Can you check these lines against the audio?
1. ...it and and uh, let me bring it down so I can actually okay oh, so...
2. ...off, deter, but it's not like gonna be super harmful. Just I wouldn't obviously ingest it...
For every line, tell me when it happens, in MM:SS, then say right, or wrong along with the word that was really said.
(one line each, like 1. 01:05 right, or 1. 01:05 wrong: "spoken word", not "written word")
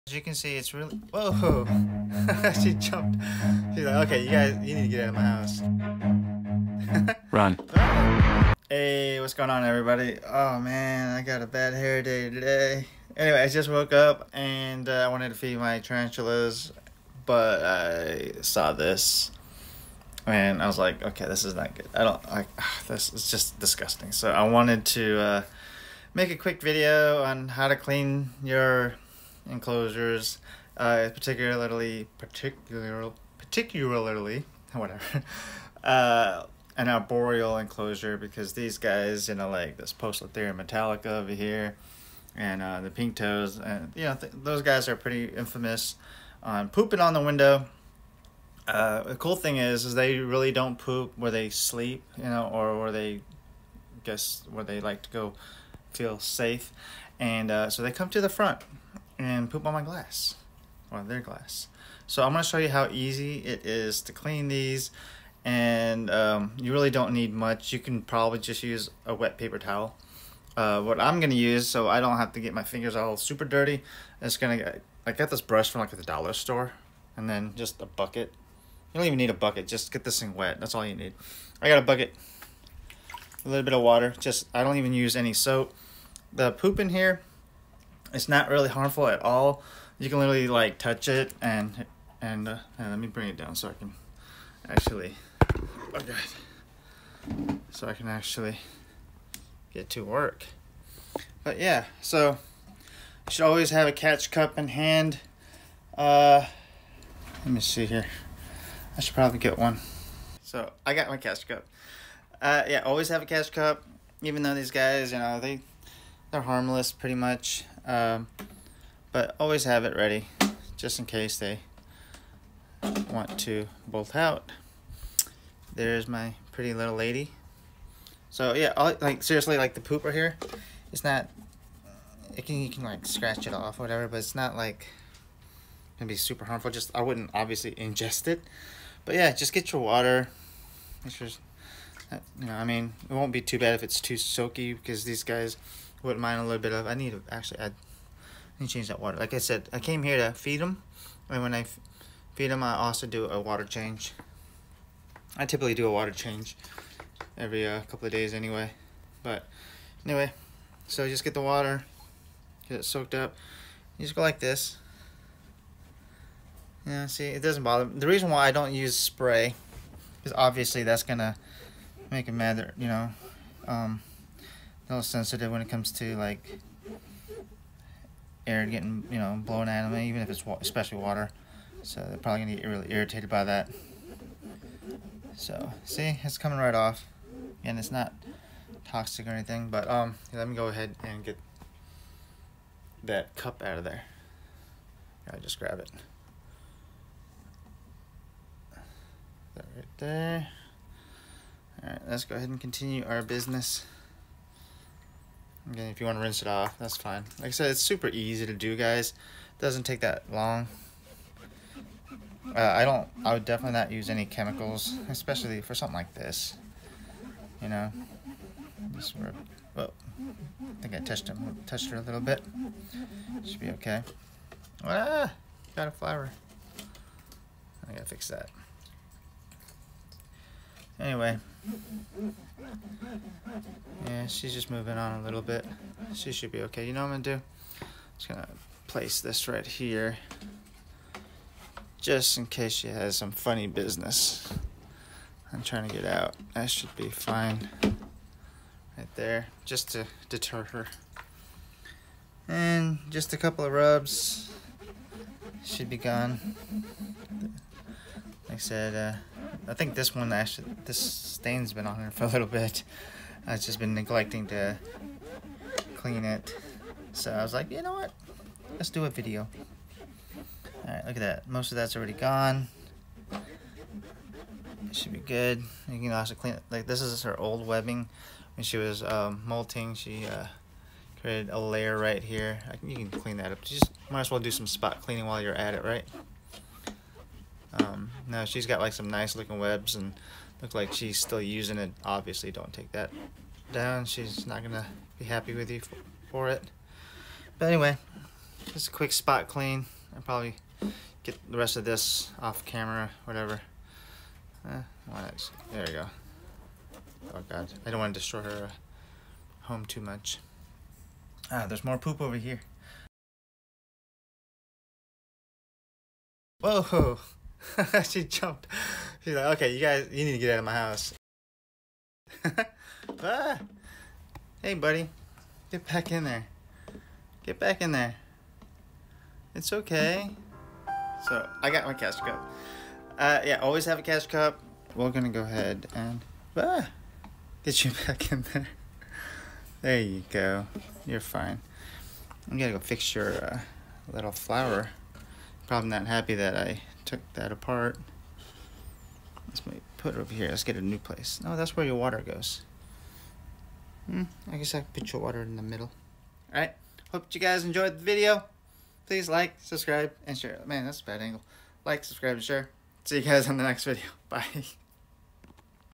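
1. 01:31 right
2. 02:13 wrong: "whatever", not "deter".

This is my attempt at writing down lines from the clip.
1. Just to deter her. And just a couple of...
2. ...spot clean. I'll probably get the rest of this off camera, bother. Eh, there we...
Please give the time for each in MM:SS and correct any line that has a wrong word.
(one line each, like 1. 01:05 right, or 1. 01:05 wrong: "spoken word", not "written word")
1. 04:09 right
2. 04:59 wrong: "whatever", not "bother".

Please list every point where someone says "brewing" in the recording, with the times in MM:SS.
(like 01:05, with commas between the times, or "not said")
not said.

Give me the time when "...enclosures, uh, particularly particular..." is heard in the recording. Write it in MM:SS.
00:29.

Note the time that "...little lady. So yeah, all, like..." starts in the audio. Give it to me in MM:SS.
02:06.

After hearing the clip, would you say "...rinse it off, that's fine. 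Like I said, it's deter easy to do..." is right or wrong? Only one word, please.
wrong.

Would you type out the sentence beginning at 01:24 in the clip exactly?
Just I don't even use any soap.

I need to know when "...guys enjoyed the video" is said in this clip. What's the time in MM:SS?
05:57.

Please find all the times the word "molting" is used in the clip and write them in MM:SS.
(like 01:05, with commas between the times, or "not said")
04:39.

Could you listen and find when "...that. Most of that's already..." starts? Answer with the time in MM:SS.
04:31.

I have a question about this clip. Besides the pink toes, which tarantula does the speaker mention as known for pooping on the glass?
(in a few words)
metallica.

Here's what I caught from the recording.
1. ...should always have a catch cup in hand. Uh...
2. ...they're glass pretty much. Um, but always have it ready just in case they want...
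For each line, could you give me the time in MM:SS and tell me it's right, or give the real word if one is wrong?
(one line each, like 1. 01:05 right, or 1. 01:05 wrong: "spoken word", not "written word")
1. 01:43 right
2. 01:56 wrong: "harmless", not "glass".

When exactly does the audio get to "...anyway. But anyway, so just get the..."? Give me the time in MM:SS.
02:38.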